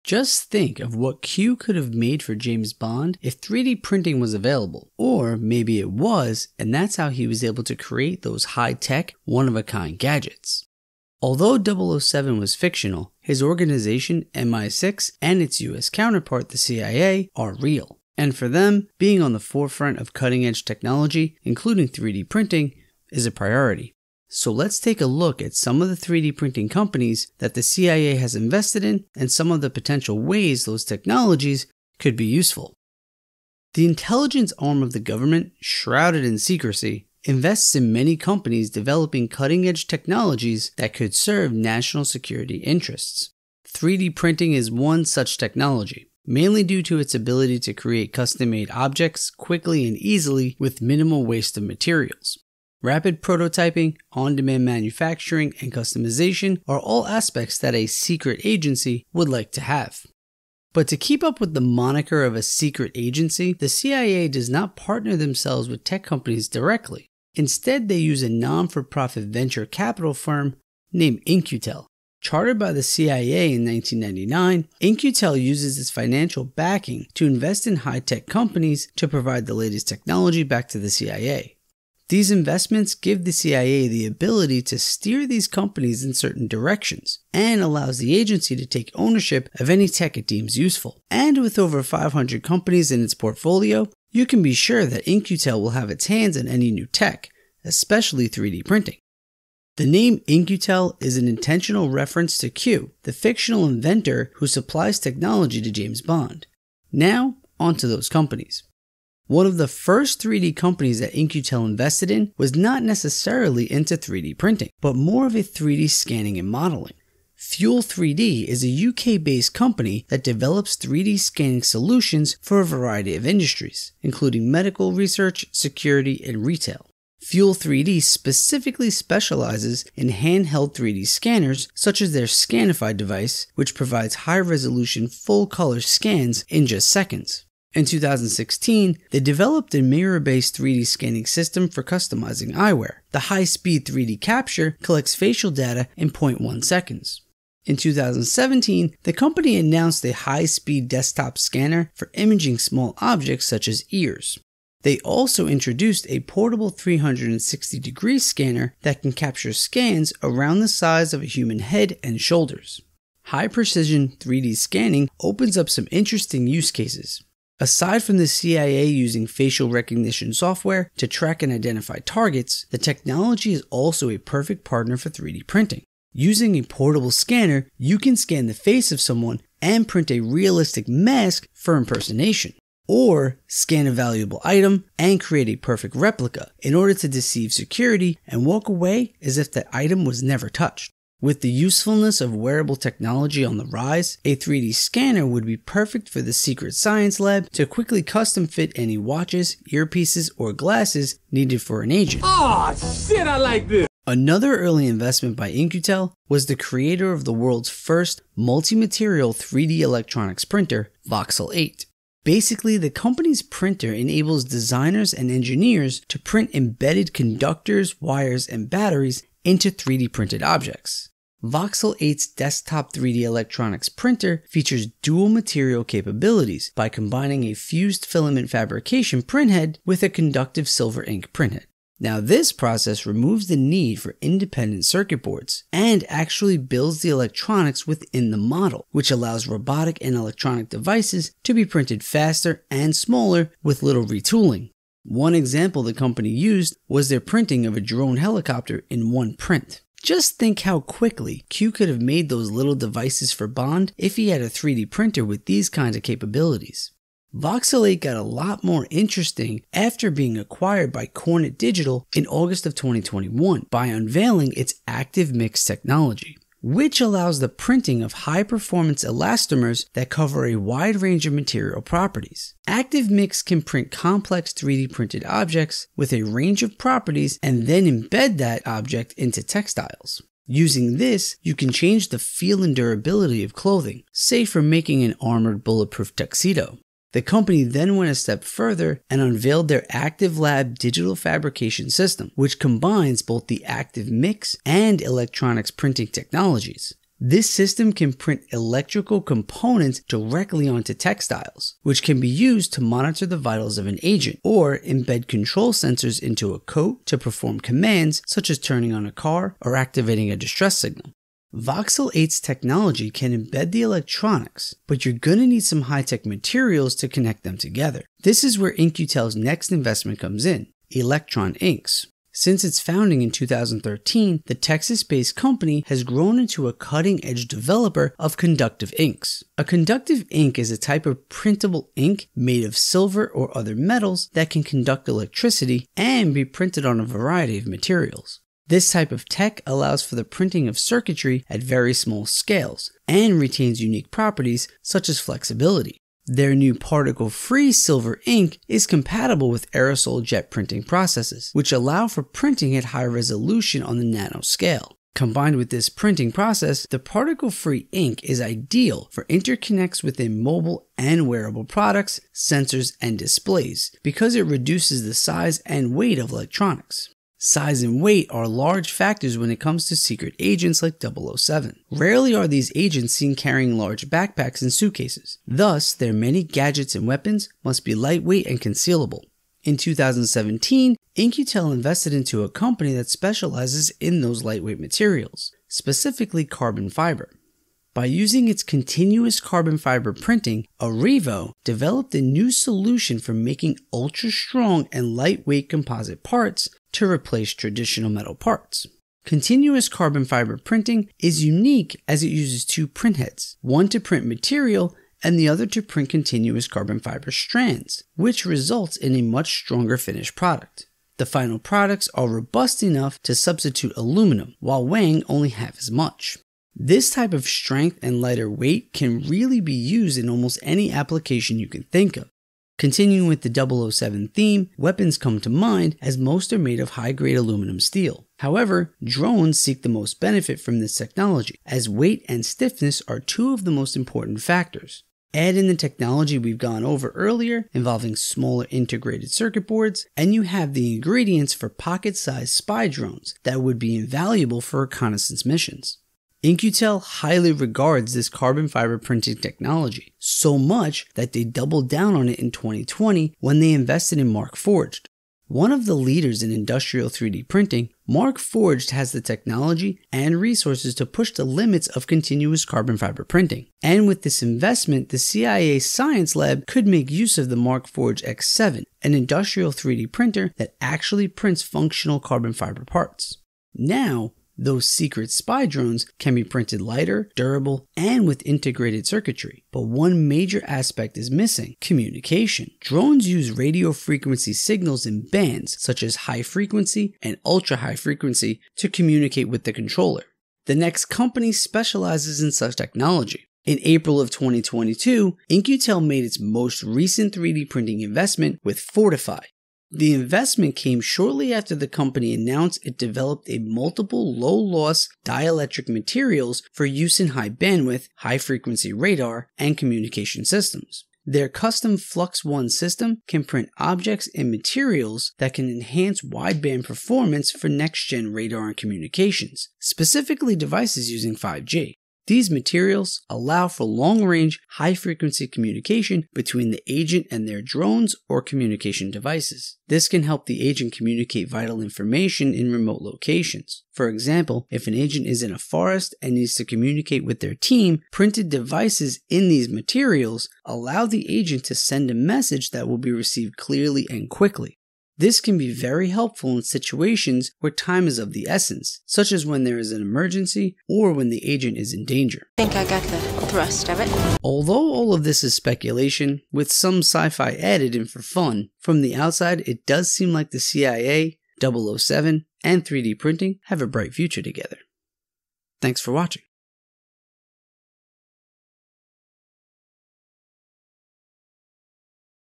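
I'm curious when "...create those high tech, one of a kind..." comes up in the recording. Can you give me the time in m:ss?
0:07.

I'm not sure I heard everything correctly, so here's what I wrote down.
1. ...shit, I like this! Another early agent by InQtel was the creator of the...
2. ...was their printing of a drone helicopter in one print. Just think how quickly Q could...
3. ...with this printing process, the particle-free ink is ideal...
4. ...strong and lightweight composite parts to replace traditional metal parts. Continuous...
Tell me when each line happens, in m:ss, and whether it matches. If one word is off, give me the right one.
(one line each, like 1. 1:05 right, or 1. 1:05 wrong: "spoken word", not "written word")
1. 3:23 wrong: "investment", not "agent"
2. 4:06 right
3. 5:55 right
4. 6:34 right.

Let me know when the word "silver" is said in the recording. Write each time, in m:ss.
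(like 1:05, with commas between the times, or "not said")
3:50, 5:32, 5:47.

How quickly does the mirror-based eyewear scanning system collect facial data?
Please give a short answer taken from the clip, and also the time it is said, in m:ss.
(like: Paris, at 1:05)
0.1 seconds, at 2:26.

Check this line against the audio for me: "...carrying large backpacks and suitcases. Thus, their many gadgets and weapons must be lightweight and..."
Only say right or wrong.
right.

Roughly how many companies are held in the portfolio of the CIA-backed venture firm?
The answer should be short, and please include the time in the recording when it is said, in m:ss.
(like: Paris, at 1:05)
over 500, at 1:31.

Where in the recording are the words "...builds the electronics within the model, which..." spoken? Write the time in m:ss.
3:56.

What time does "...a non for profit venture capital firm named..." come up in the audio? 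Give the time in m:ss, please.
1:08.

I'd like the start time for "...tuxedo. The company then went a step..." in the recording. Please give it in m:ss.
4:46.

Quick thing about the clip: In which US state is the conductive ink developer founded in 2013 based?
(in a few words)
Texas.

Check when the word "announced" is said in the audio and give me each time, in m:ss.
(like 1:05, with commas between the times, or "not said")
2:29, 8:22.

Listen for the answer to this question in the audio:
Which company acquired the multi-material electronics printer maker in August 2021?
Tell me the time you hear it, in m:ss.
4:21.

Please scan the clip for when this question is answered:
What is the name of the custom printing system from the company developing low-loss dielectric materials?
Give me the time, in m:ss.
8:31.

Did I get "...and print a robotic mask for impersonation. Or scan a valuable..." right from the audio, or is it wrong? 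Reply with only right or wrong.
wrong.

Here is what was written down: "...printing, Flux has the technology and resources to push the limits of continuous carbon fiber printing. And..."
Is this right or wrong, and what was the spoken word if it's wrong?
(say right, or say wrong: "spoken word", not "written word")
wrong: "MarkForged", not "Flux".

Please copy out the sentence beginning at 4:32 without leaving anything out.
ActiveMix can print complex 3D printed objects with a range of properties and then embed that object into textiles.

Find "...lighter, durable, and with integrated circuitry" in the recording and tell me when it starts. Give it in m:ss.
7:56.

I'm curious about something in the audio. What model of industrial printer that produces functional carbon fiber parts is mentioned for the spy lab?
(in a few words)
Markforged X7.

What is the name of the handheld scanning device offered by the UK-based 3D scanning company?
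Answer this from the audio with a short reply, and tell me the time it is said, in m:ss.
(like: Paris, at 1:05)
Scanify, at 2:12.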